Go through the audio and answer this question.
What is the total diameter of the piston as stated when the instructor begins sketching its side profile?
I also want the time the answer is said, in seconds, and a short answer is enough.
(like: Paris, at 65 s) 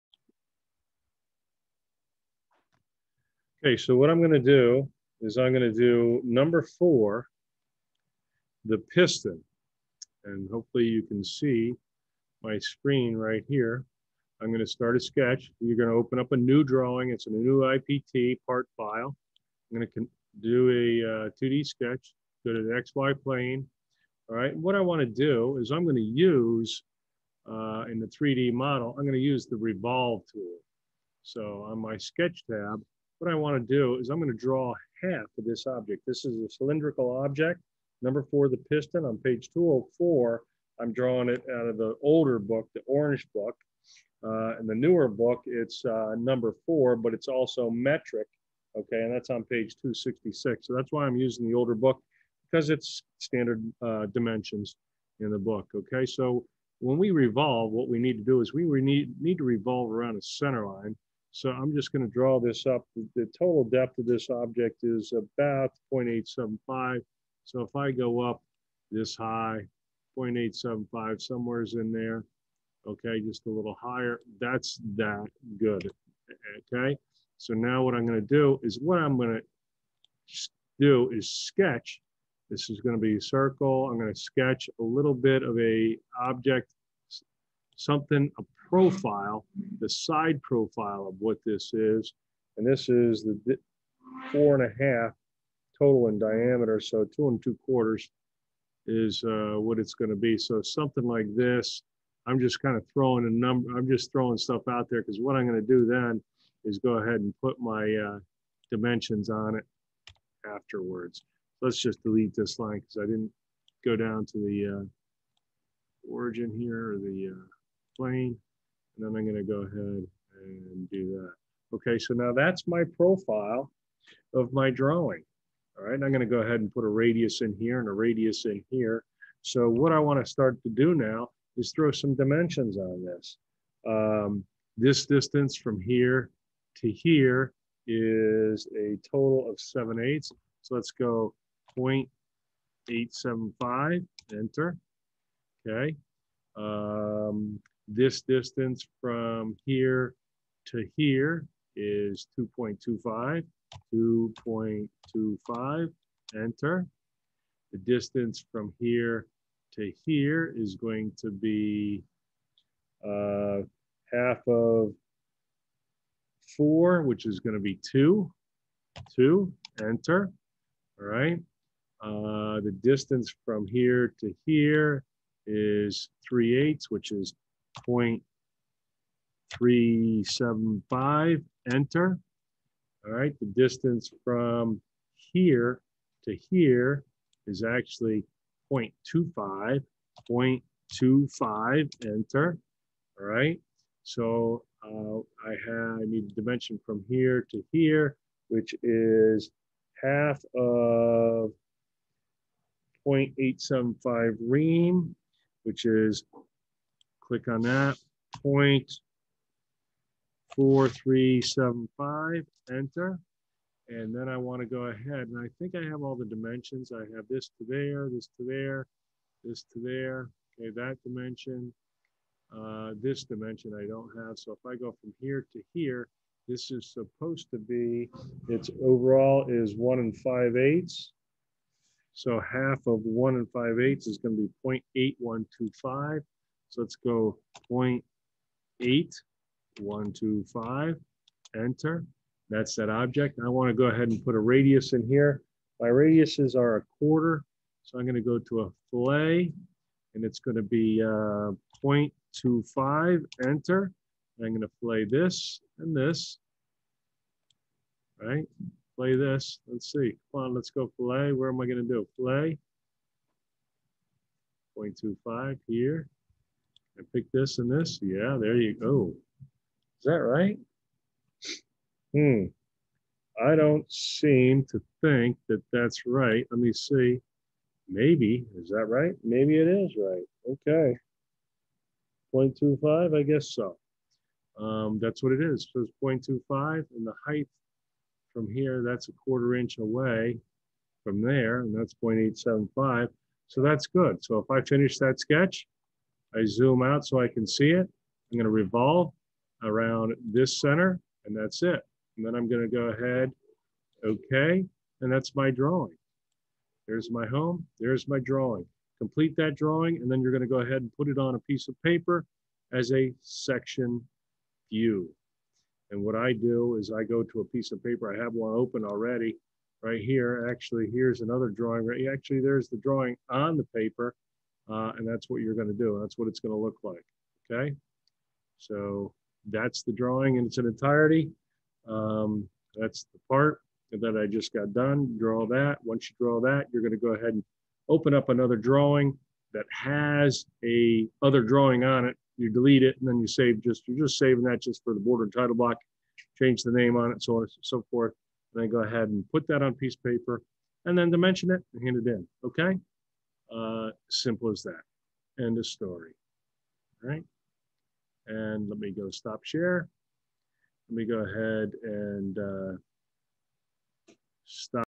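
4.5, at 94 s.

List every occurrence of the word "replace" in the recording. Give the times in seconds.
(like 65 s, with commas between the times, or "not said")
not said.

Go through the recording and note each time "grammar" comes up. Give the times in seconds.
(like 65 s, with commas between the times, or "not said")
not said.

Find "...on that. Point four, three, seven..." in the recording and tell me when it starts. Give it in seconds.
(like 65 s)
207 s.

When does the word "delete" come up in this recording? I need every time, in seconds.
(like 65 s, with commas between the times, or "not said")
112 s, 342 s.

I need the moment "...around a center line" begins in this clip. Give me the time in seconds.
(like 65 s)
59 s.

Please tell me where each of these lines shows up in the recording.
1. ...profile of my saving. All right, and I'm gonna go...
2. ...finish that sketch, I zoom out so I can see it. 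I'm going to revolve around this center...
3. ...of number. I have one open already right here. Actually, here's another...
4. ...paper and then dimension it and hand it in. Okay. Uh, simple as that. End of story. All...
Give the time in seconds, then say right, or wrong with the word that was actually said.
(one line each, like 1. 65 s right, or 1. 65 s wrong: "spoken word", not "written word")
1. 122 s wrong: "drawing", not "saving"
2. 294 s right
3. 317 s wrong: "paper", not "number"
4. 350 s right.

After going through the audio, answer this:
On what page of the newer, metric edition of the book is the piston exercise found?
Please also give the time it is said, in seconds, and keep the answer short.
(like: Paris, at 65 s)
266, at 49 s.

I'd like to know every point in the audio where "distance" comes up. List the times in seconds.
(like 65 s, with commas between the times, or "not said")
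135 s, 148 s, 157 s, 172 s, 183 s.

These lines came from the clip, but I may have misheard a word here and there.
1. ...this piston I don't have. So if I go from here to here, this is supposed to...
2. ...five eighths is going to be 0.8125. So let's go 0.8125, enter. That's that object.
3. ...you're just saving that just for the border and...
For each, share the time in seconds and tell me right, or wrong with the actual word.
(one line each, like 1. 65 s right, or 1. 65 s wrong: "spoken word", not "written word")
1. 223 s wrong: "dimension", not "piston"
2. 233 s right
3. 343 s right.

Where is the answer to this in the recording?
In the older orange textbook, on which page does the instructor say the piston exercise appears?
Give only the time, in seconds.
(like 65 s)
39 s.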